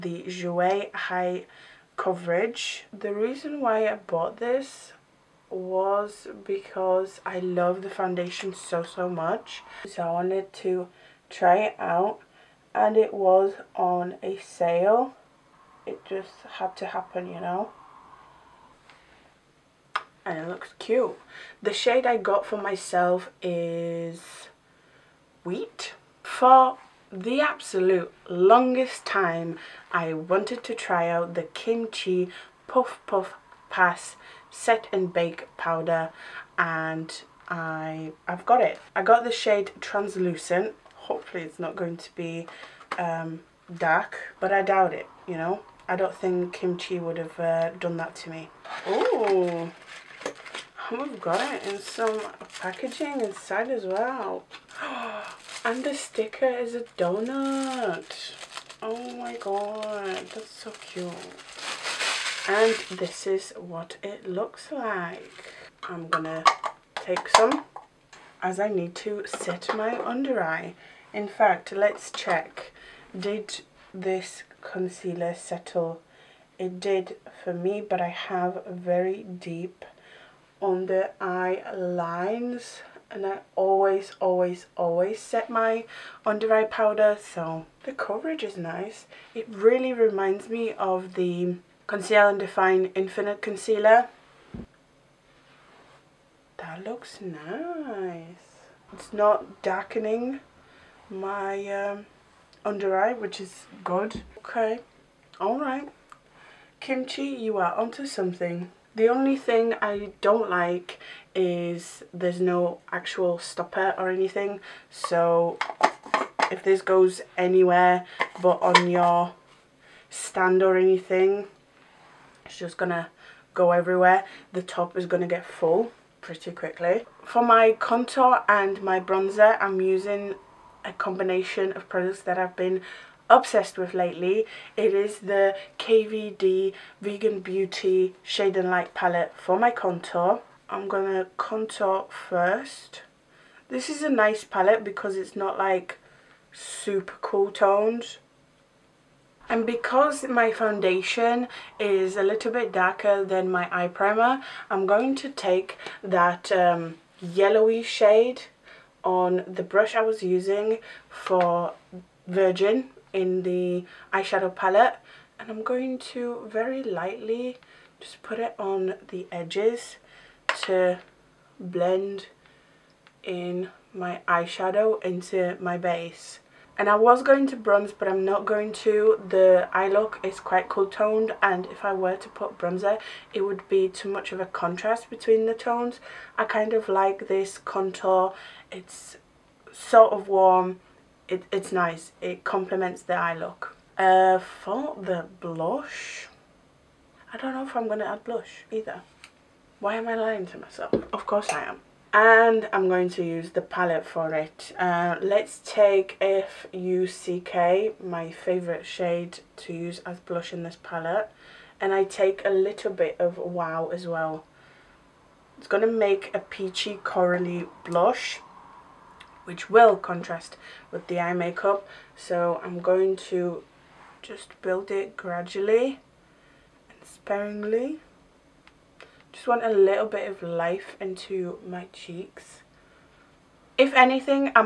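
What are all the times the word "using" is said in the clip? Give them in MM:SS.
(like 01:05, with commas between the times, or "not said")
02:09, 02:40.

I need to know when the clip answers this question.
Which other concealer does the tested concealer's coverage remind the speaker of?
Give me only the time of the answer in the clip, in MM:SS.
01:31.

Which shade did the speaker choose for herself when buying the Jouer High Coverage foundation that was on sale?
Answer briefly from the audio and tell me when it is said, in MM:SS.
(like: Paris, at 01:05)
Wheat, at 00:25.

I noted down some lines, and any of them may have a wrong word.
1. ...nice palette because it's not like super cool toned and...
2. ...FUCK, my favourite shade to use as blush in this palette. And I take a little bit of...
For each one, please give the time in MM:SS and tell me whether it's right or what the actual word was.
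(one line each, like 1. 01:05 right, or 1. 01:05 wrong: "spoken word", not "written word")
1. 02:24 right
2. 03:26 right.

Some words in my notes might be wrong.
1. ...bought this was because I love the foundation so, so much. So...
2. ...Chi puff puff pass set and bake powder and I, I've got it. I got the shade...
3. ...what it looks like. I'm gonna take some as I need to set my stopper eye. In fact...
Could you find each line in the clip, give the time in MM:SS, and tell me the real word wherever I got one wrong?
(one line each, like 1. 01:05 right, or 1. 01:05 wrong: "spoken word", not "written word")
1. 00:03 right
2. 00:31 right
3. 01:03 wrong: "under", not "stopper".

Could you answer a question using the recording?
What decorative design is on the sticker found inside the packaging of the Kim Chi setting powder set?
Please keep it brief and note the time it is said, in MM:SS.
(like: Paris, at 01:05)
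A donut, at 00:56.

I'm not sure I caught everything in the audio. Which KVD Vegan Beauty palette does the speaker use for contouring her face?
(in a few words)
Shade and Light.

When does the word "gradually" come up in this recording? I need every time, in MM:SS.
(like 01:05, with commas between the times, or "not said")
03:45.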